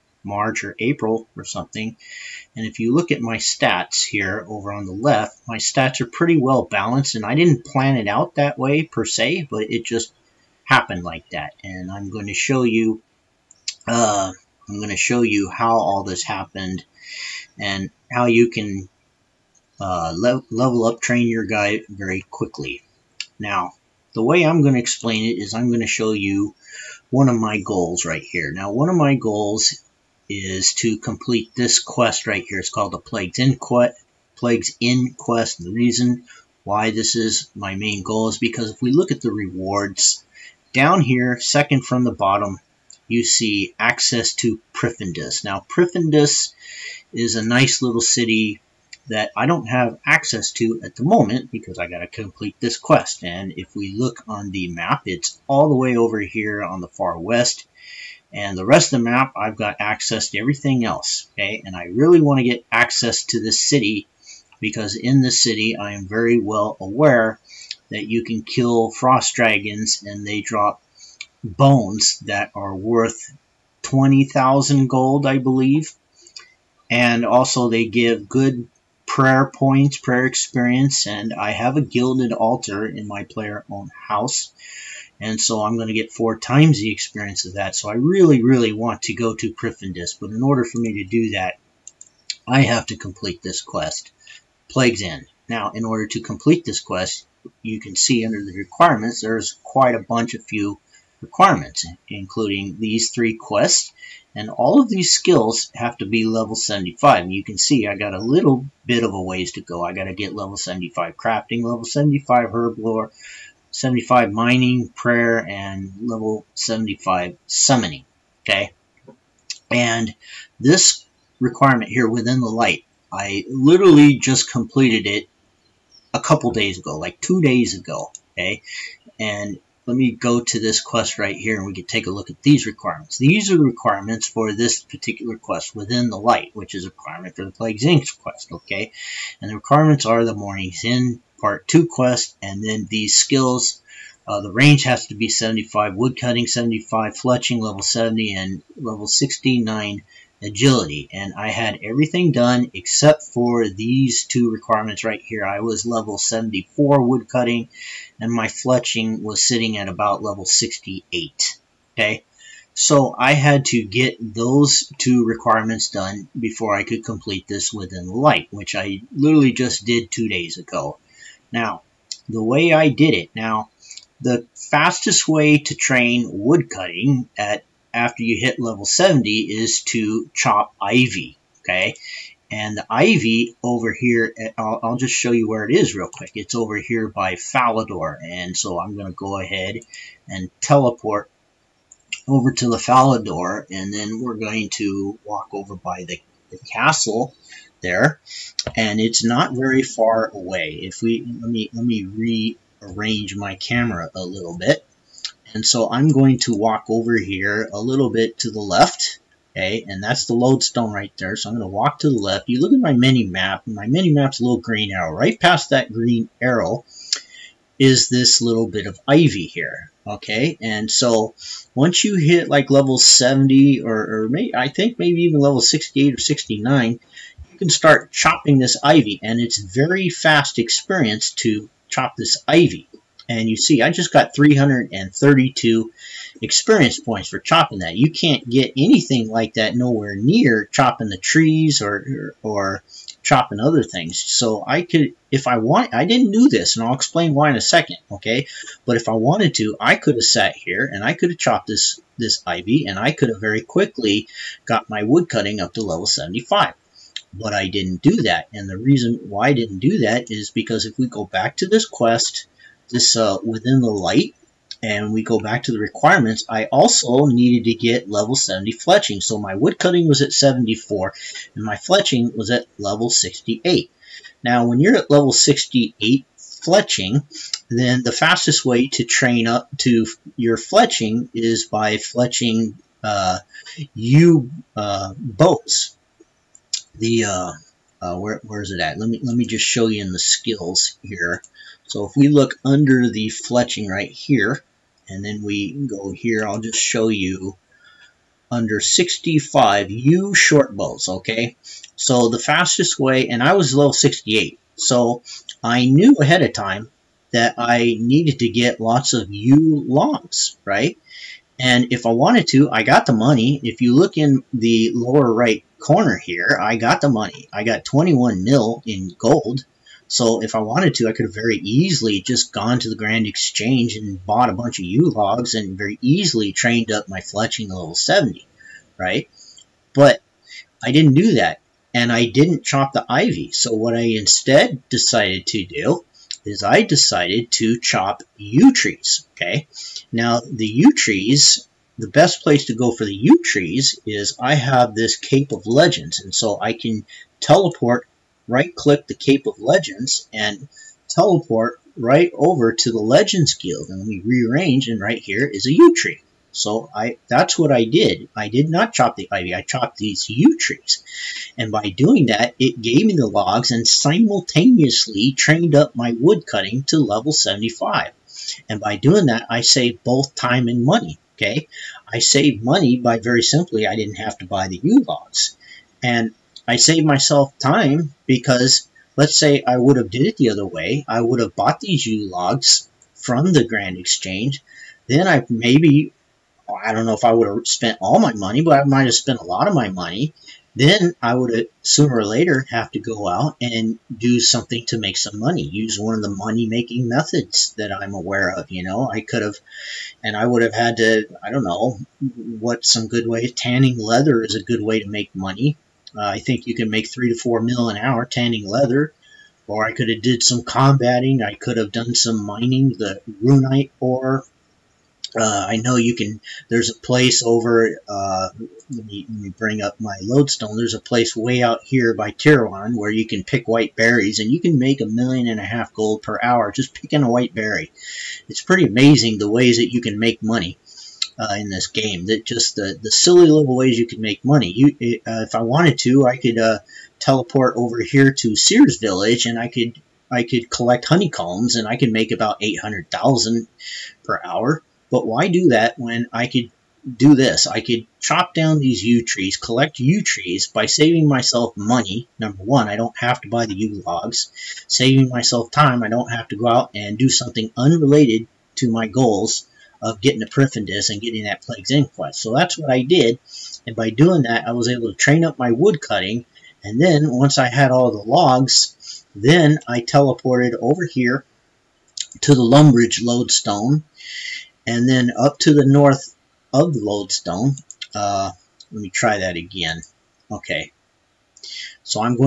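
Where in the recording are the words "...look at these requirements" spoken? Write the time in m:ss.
2:12.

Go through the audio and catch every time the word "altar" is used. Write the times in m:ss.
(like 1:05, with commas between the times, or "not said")
1:22.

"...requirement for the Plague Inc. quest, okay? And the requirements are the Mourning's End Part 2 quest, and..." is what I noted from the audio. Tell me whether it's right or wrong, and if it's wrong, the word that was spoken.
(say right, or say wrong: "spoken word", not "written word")
right.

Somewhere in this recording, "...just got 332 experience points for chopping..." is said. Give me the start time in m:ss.
3:53.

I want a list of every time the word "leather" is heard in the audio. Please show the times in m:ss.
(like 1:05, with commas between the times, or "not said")
6:43, 6:48.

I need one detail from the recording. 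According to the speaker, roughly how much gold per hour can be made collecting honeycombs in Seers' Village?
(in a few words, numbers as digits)
800,000.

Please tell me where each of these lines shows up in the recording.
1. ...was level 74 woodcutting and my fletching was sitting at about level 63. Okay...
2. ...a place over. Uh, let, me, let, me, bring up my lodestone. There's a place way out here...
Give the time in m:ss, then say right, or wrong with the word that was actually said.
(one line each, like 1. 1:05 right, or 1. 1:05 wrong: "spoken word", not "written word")
1. 2:35 wrong: "68", not "63"
2. 6:56 right.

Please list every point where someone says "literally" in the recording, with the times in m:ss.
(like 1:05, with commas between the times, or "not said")
2:03, 2:49.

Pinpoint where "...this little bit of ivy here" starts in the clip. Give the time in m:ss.
3:38.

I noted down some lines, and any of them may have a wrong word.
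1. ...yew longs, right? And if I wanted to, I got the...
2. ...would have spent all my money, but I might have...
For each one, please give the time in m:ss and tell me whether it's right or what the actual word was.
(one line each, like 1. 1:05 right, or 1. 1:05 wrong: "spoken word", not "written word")
1. 5:09 right
2. 6:27 right.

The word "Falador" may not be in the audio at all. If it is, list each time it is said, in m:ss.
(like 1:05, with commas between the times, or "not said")
3:07, 3:12.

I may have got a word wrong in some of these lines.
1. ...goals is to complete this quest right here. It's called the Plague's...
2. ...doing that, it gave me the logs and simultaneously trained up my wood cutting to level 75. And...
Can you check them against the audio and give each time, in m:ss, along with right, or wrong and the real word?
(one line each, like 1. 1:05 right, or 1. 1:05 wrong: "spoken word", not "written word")
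1. 0:29 right
2. 6:01 right.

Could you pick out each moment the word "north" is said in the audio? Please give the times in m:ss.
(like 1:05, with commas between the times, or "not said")
7:55.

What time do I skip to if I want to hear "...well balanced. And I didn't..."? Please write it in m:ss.
0:06.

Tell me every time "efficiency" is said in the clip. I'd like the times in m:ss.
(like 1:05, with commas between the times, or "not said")
not said.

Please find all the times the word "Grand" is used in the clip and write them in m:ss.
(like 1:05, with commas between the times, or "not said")
5:22, 6:23.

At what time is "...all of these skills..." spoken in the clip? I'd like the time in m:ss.
1:44.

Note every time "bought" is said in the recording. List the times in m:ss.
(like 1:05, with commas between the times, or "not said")
5:24, 6:21.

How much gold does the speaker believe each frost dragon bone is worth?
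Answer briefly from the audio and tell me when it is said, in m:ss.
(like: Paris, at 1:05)
20,000 gold, at 1:13.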